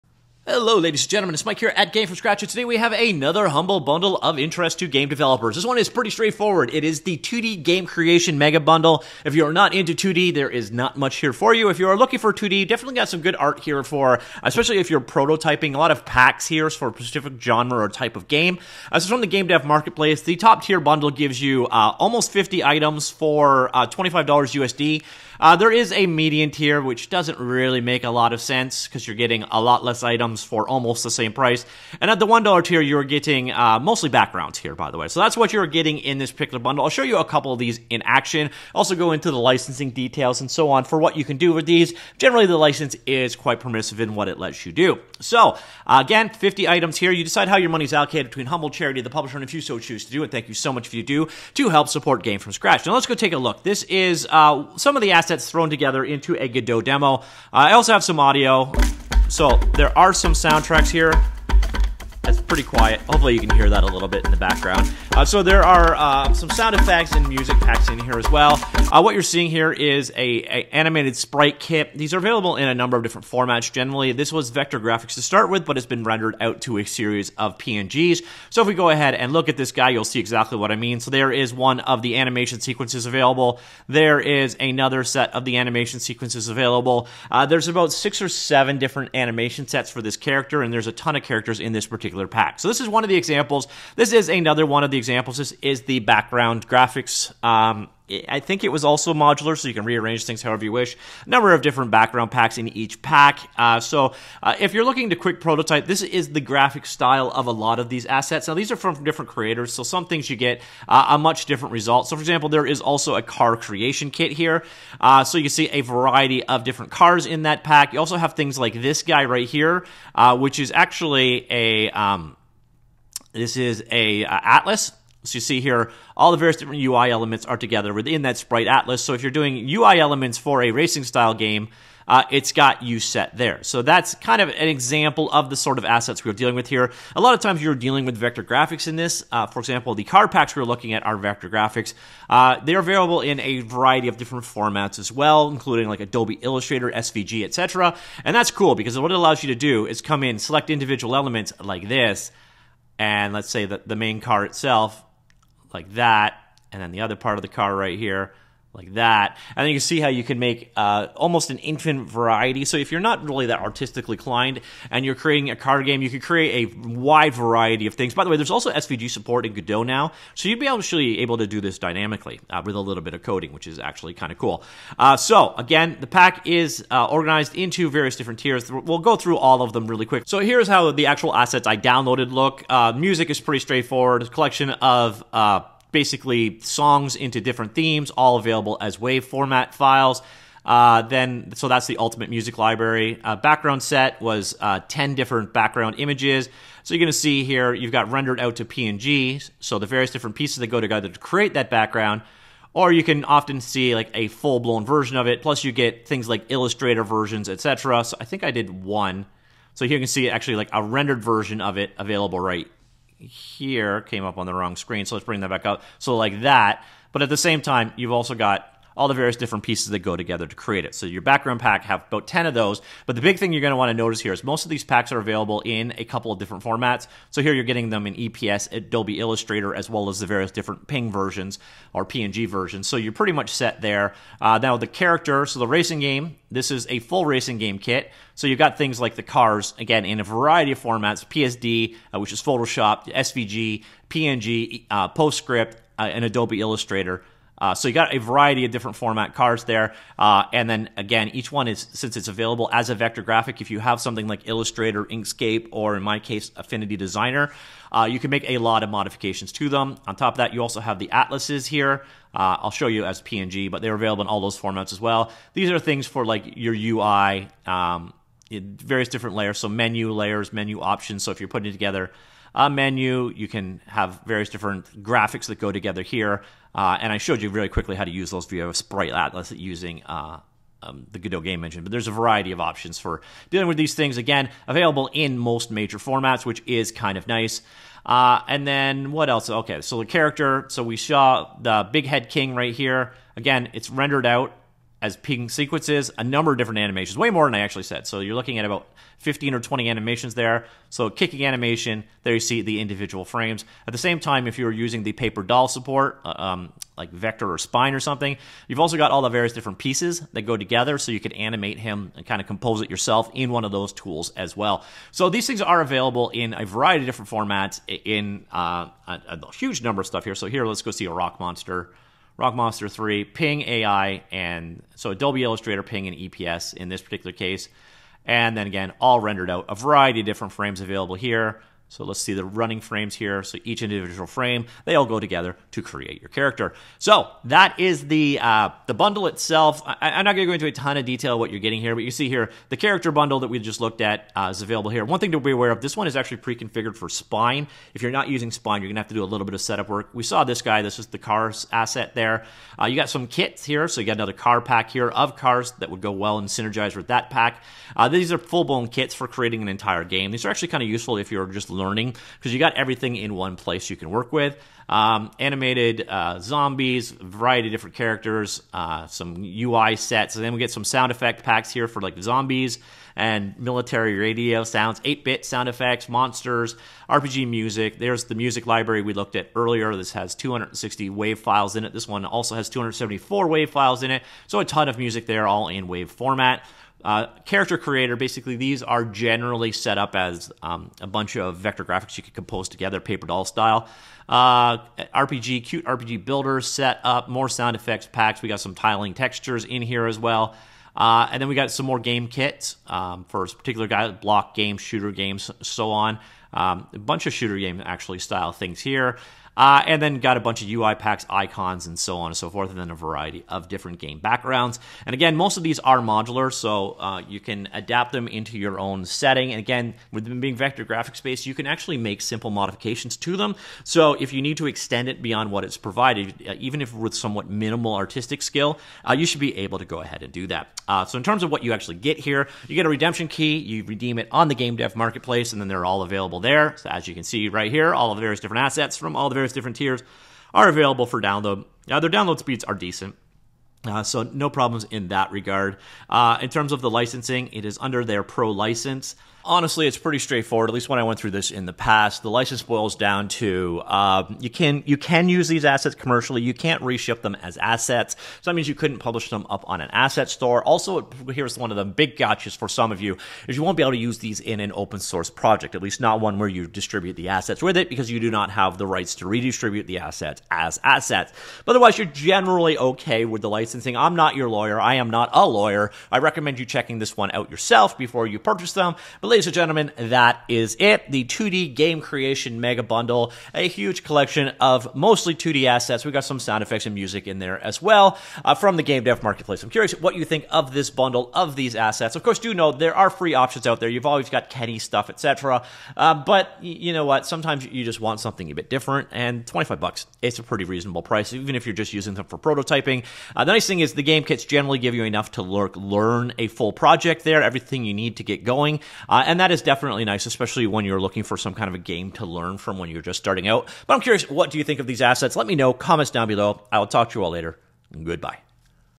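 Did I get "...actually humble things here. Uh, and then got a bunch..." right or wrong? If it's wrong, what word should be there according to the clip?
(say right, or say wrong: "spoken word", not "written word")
wrong: "style", not "humble".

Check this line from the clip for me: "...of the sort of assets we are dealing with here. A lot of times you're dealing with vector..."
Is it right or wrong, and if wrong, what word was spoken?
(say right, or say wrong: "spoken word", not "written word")
right.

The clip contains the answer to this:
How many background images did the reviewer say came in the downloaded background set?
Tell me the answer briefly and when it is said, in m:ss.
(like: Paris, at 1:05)
10, at 3:14.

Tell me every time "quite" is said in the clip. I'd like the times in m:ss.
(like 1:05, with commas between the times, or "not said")
0:43.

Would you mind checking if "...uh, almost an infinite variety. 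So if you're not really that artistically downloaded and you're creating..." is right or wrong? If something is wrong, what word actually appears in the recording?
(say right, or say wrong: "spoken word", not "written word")
wrong: "inclined", not "downloaded".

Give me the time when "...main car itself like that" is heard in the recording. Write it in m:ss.
2:33.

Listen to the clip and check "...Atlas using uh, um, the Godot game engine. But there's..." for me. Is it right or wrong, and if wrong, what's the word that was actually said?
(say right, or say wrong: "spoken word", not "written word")
right.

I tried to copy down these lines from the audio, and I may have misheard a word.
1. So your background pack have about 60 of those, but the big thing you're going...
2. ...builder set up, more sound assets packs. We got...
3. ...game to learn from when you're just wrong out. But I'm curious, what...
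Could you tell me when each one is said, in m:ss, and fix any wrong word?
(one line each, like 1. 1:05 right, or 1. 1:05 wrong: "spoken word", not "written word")
1. 3:40 wrong: "10", not "60"
2. 6:36 wrong: "effects", not "assets"
3. 8:31 wrong: "starting", not "wrong".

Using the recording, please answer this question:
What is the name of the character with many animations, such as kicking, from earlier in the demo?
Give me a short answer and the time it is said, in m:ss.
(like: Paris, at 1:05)
Big Head King, at 4:51.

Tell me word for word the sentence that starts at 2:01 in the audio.
Um, this is a uh, Atlas so you see here, all the various different UI elements are together within that sprite atlas.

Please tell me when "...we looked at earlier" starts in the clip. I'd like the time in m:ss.
6:19.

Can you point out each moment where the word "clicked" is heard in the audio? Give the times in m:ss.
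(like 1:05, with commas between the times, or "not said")
not said.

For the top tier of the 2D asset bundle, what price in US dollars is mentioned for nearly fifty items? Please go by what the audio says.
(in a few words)
$25.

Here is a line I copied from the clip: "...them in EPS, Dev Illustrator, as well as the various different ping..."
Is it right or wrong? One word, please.
wrong.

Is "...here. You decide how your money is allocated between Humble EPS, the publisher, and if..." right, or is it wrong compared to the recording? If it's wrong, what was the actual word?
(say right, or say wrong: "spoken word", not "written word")
wrong: "Charity", not "EPS".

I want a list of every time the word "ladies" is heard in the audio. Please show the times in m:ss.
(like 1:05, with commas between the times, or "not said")
0:00, 7:59.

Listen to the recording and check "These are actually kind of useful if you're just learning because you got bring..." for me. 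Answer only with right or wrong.
wrong.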